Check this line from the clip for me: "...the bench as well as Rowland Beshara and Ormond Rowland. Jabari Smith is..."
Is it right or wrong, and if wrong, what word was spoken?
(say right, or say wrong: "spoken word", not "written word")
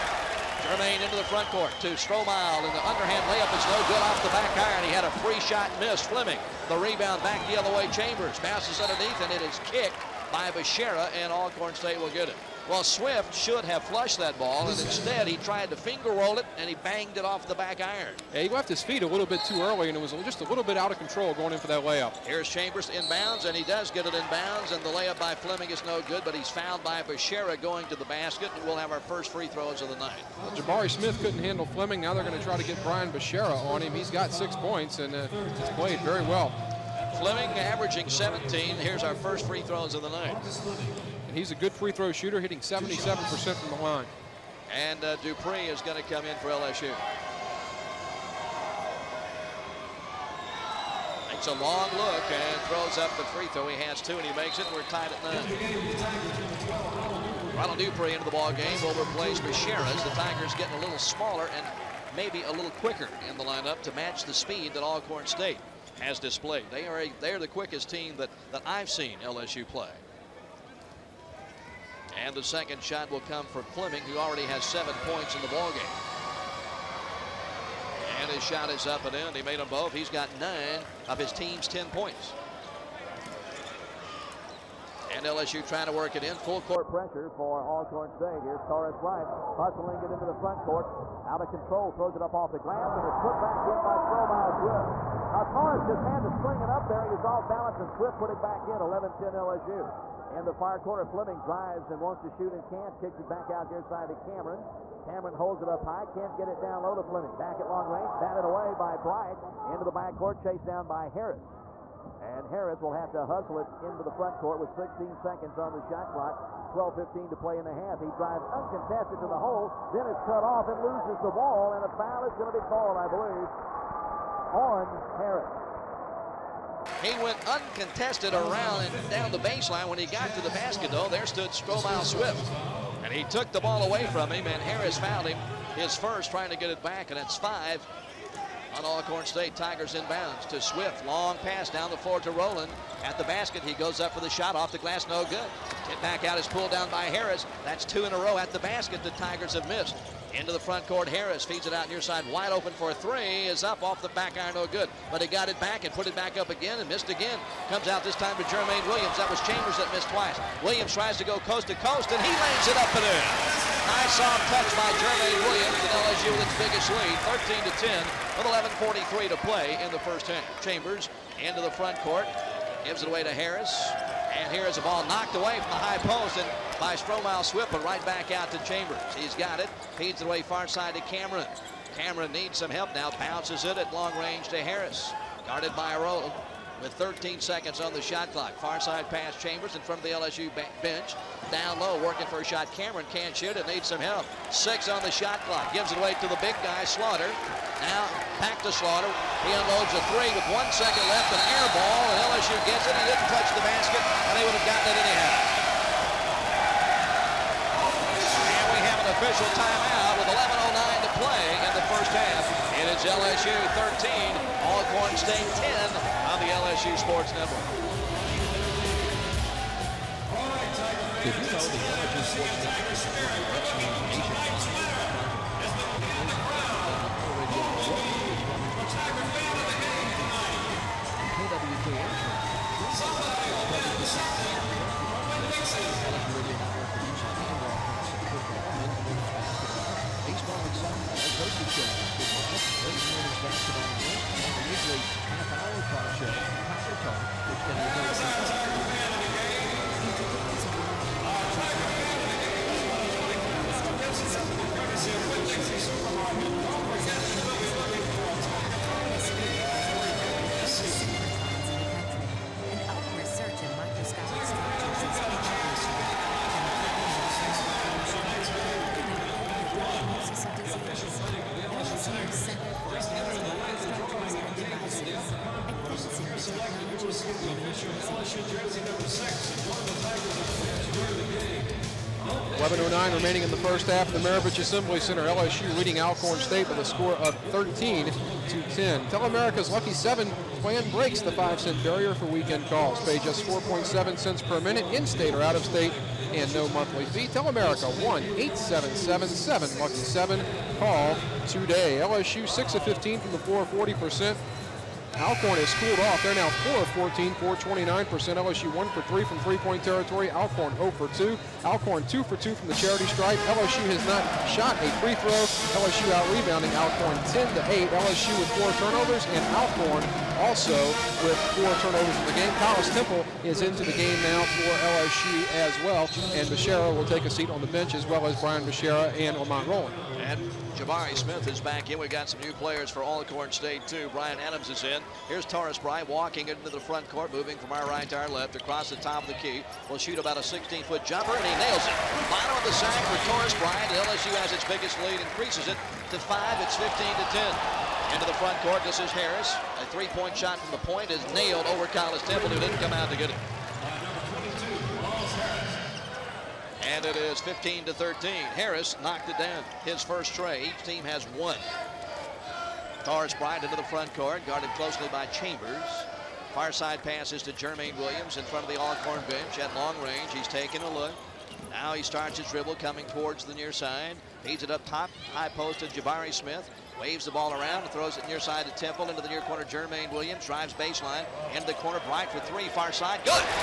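wrong: "Brian", not "Rowland".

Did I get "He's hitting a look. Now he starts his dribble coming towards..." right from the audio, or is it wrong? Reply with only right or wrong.
wrong.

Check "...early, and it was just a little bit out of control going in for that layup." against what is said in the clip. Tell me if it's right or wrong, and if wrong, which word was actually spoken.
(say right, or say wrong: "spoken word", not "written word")
right.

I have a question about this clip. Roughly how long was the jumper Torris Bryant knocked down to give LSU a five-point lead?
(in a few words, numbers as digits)
16 feet.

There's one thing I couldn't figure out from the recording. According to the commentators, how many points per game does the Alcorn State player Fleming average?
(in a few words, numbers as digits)
17.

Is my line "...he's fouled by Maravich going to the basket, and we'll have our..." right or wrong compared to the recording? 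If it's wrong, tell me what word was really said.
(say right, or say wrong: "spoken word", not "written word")
wrong: "Beshara", not "Maravich".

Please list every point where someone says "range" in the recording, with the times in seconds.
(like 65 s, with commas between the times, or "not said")
107 s, 184 s, 370 s.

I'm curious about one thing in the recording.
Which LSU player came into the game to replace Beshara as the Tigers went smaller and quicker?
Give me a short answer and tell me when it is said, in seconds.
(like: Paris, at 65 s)
Ronald Dupree, at 57 s.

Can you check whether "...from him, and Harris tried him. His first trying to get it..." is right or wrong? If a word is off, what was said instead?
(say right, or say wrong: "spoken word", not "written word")
wrong: "fouled", not "tried".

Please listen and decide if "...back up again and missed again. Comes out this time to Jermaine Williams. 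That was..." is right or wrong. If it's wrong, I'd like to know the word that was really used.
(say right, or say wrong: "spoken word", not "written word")
right.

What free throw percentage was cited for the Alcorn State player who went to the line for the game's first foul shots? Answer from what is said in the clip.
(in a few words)
77%.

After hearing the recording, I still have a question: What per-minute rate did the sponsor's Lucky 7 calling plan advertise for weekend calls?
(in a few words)
4.7 cents.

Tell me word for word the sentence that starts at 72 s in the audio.
And the second shot will come for Fleming, who already has seven points in the ballgame.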